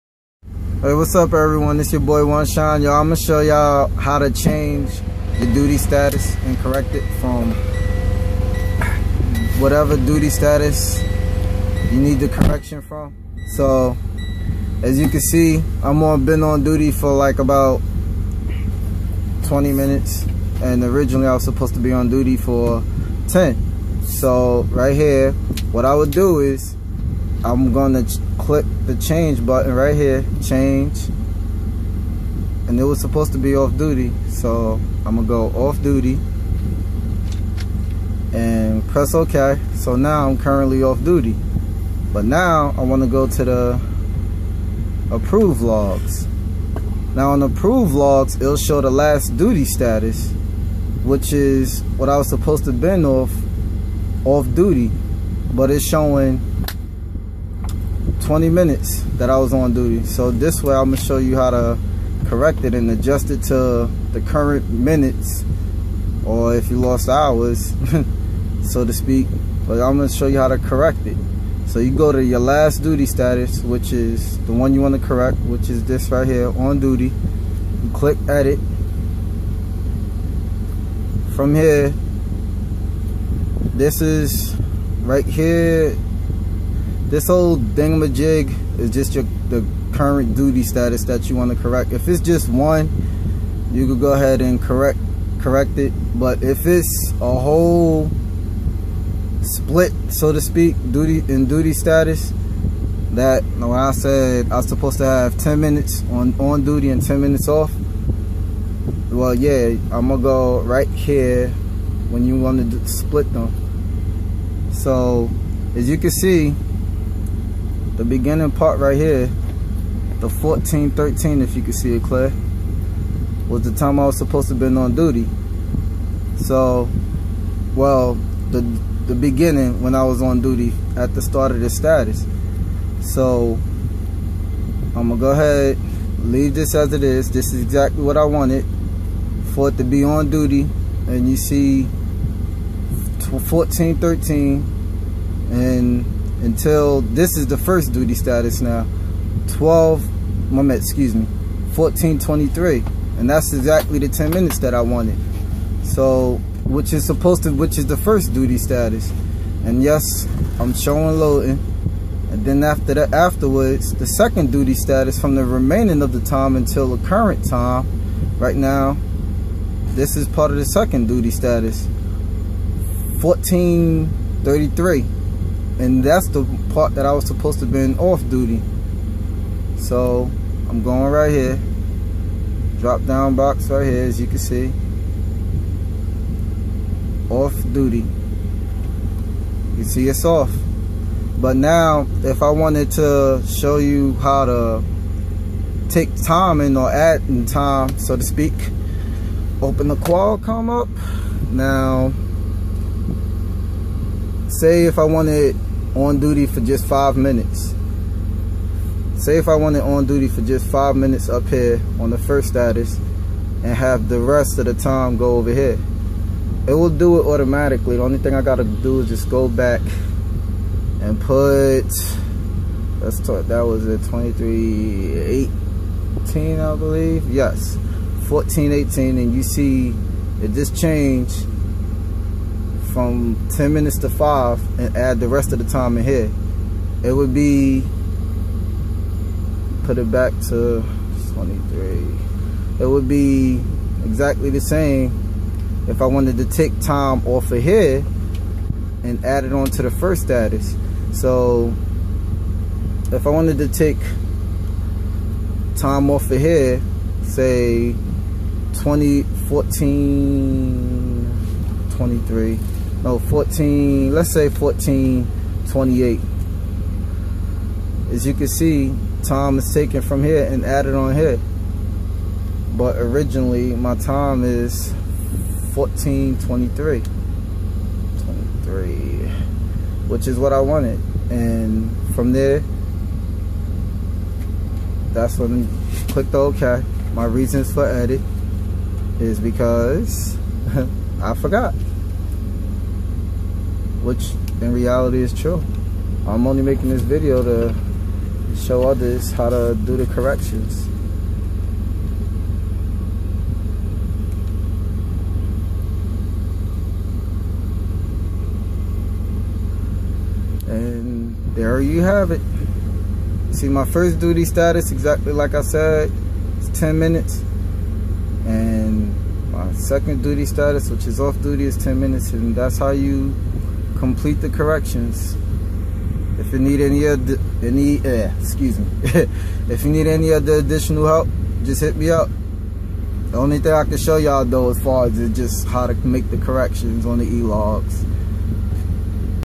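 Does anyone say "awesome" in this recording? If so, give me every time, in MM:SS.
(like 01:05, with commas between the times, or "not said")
not said.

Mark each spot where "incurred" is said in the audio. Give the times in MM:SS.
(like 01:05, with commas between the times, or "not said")
not said.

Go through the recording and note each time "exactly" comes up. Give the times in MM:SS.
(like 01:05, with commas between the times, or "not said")
02:17, 02:33, 04:04, 05:14.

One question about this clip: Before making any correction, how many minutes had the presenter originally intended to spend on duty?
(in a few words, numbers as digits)
10.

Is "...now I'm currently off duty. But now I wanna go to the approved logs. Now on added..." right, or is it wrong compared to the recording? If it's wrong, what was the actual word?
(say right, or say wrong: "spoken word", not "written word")
wrong: "approved", not "added".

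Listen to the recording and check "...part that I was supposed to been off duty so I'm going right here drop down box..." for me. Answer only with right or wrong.
right.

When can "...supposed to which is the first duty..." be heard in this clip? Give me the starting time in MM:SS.
02:37.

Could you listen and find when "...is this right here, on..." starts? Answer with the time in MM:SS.
01:15.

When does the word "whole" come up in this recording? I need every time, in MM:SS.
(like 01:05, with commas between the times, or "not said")
01:27, 01:37.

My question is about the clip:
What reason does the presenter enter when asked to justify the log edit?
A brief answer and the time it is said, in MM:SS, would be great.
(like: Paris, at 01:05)
I forgot, at 04:51.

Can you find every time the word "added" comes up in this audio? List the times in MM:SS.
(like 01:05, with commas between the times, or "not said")
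04:30.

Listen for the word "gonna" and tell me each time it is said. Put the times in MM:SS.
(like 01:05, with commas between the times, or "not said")
00:03, 00:27, 00:35, 01:00, 01:09, 01:50, 02:15.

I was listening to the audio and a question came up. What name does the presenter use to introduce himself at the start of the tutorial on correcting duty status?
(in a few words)
One Shine.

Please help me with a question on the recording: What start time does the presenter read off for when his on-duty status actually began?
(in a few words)
1413.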